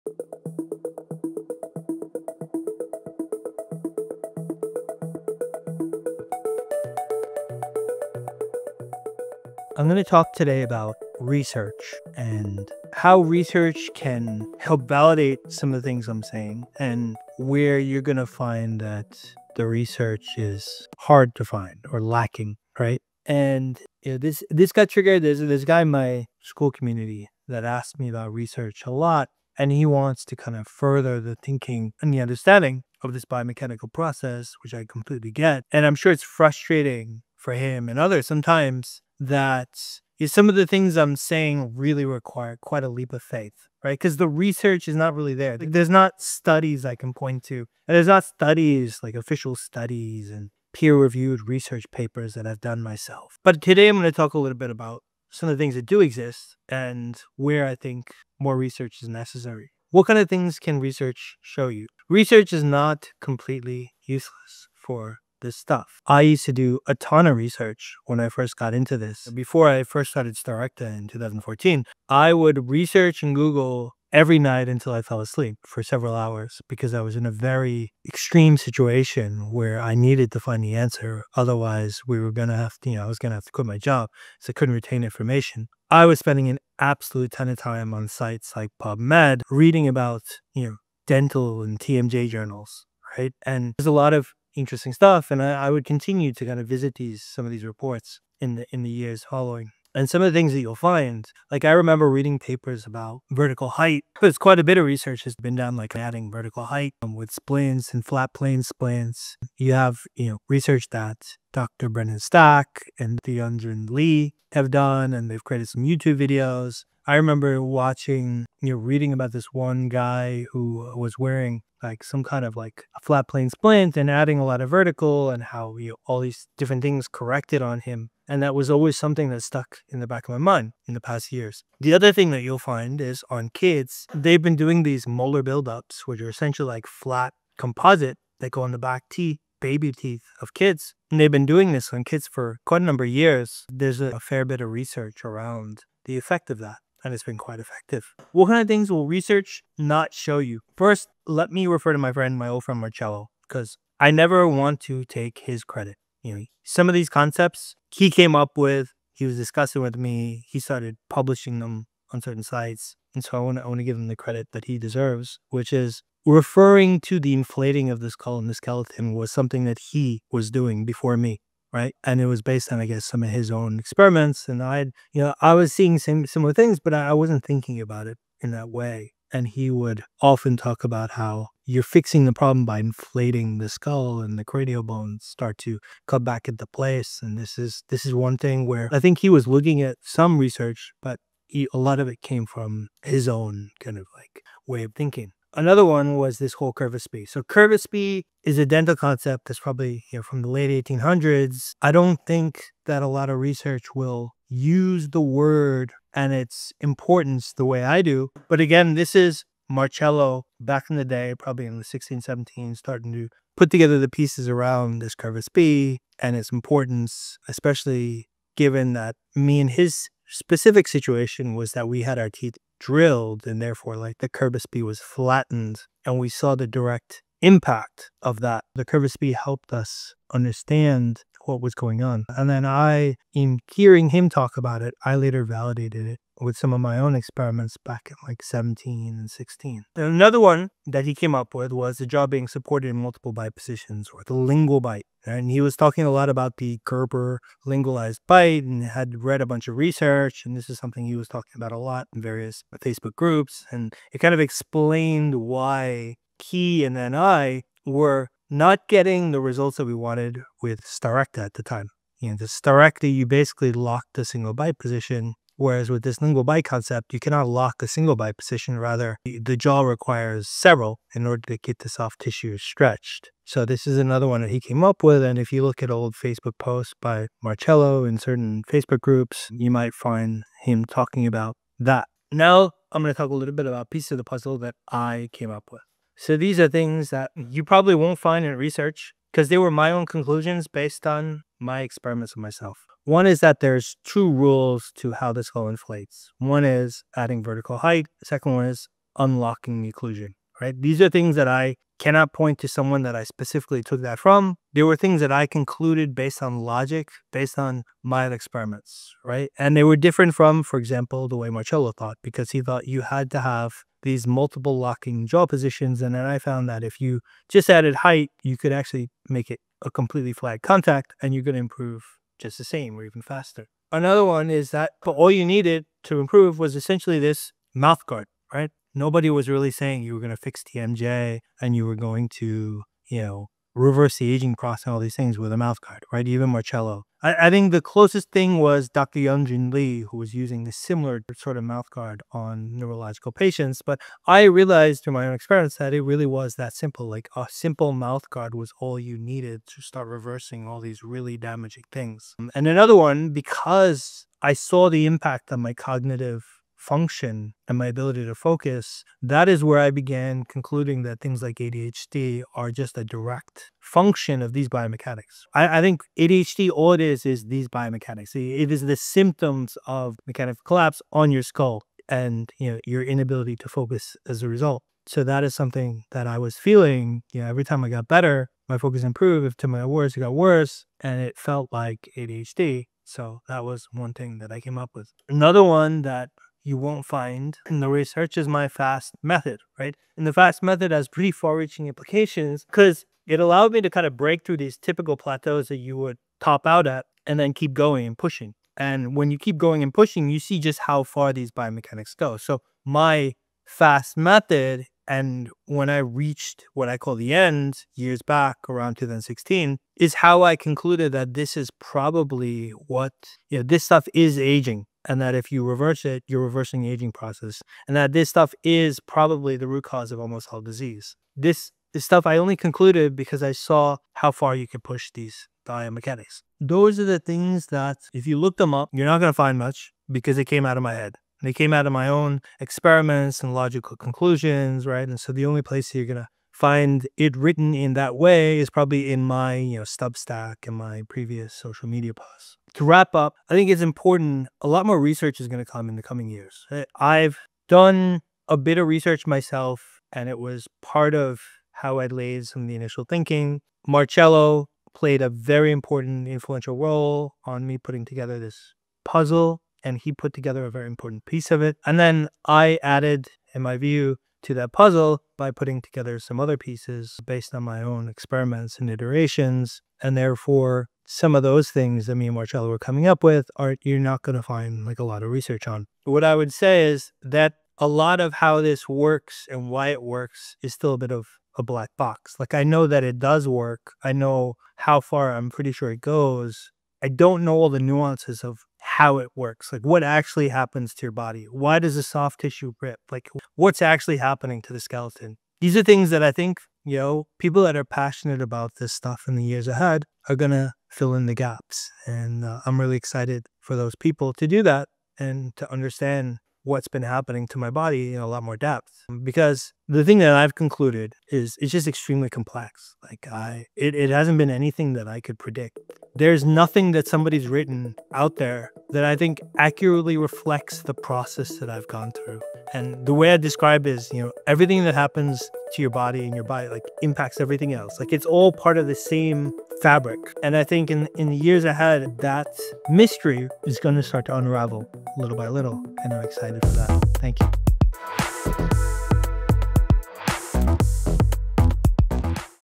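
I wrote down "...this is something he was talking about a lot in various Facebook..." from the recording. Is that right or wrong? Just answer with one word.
right.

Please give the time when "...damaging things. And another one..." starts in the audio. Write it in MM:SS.
05:51.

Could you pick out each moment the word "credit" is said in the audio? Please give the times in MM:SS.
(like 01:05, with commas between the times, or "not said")
02:35, 02:44.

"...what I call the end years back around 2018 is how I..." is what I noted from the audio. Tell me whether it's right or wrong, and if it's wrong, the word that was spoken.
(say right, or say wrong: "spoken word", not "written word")
wrong: "2016", not "2018".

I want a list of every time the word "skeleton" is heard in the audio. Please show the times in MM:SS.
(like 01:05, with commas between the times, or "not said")
02:48, 08:14.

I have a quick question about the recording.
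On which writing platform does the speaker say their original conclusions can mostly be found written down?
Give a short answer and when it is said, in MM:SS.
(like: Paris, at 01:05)
Substack, at 07:19.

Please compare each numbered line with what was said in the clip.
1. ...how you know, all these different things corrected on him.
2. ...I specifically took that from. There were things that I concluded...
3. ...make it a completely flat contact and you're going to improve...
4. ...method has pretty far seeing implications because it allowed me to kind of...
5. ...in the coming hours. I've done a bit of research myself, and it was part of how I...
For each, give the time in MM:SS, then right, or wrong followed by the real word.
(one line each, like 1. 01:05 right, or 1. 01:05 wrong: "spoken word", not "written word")
1. 02:05 right
2. 05:03 right
3. 05:19 right
4. 06:30 wrong: "reaching", not "seeing"
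5. 07:25 wrong: "years", not "hours".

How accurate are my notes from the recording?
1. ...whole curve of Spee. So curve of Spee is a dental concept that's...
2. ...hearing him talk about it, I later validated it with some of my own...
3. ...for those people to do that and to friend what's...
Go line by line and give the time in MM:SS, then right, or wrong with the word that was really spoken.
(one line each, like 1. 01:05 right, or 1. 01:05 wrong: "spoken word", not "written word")
1. 03:16 right
2. 03:53 right
3. 08:23 wrong: "understand", not "friend".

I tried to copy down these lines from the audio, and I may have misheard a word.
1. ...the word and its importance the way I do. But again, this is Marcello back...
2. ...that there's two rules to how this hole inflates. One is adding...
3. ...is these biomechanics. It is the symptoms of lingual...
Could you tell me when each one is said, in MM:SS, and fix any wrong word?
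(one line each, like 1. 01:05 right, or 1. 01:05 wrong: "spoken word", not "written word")
1. 03:25 right
2. 04:53 right
3. 06:07 wrong: "mechanical", not "lingual".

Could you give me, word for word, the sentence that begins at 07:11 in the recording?
They came out of my own experiments and logical conclusions, right?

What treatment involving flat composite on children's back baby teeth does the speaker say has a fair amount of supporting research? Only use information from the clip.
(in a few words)
Molar buildups.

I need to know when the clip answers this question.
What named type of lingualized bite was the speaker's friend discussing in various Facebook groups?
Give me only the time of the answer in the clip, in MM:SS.
04:06.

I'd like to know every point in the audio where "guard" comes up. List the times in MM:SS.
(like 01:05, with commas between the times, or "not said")
05:28, 05:35, 05:41, 05:48.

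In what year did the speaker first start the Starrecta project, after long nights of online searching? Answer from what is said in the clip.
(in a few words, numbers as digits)
2014.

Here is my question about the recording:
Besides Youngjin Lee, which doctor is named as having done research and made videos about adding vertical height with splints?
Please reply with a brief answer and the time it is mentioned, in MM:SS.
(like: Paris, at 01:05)
Dr. Brendan Stack, at 01:51.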